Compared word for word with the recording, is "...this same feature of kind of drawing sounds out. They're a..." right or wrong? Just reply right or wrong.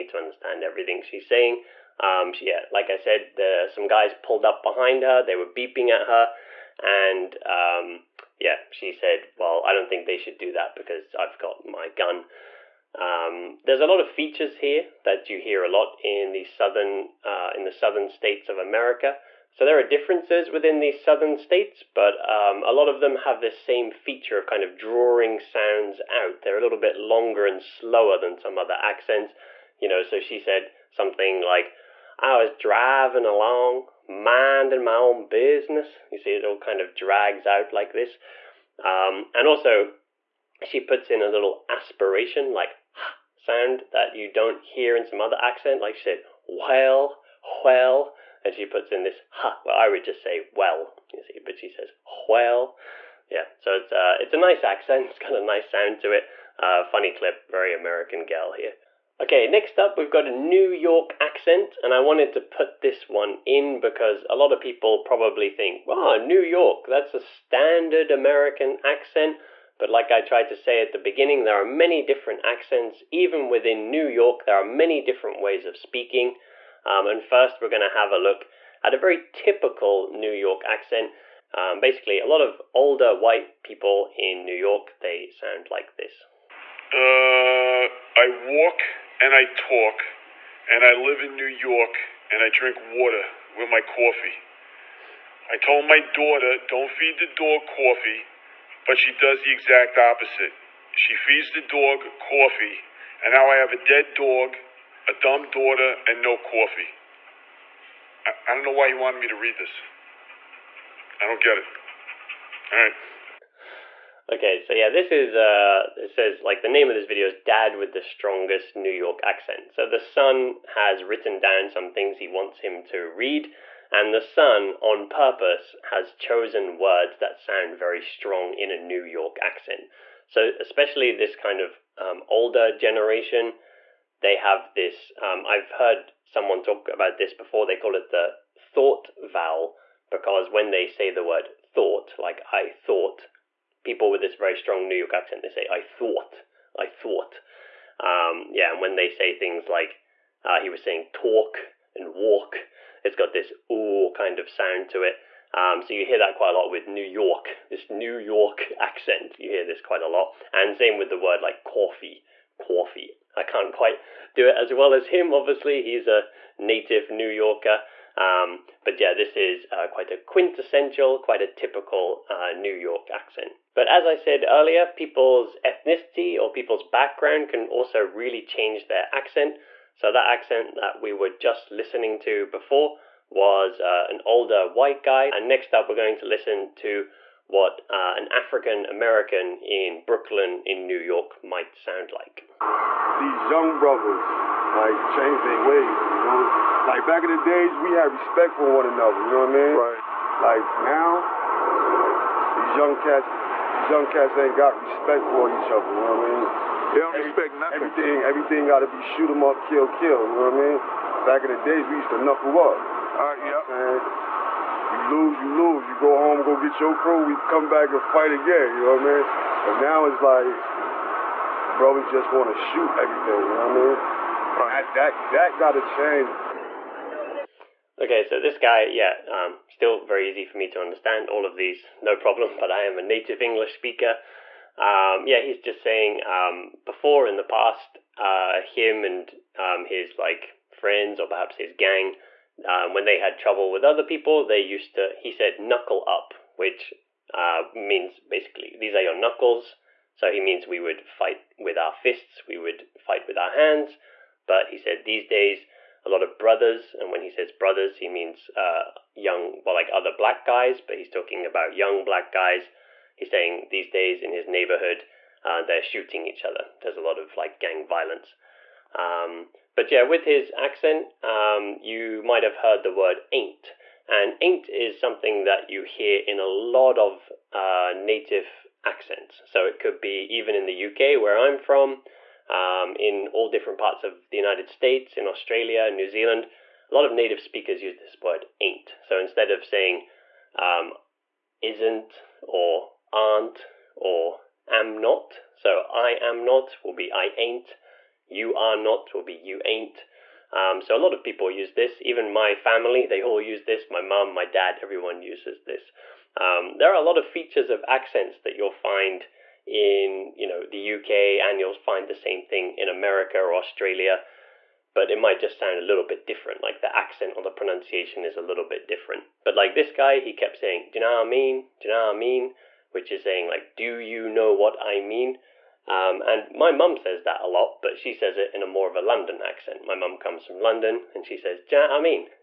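right.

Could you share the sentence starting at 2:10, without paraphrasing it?
So especially this kind of um, older generation, they have this.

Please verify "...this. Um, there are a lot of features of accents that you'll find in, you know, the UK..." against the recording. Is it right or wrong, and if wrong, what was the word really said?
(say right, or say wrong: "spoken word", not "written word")
right.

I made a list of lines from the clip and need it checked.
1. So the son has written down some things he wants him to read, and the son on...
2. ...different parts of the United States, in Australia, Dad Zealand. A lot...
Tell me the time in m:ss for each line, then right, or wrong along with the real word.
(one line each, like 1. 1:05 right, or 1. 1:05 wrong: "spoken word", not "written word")
1. 1:59 right
2. 4:43 wrong: "New", not "Dad".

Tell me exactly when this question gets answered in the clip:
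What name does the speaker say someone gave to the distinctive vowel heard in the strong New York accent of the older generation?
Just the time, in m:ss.
2:18.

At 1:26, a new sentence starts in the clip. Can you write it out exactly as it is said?
Uh, I walk and I talk, and I live in New York, and I drink water with my coffee.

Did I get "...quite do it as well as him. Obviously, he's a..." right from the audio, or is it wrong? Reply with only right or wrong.
right.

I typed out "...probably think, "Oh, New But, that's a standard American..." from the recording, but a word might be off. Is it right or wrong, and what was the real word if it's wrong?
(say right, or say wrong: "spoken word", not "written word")
wrong: "York", not "But".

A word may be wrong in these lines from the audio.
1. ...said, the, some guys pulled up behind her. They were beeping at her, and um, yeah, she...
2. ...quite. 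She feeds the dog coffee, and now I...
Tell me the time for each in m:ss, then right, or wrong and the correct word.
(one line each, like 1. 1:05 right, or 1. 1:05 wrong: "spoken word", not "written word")
1. 0:02 right
2. 1:39 wrong: "opposite", not "quite".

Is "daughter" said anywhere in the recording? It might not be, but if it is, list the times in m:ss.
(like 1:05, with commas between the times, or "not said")
1:36, 1:45.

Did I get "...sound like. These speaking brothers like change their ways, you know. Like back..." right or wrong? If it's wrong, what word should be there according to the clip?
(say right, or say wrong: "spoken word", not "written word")
wrong: "young", not "speaking".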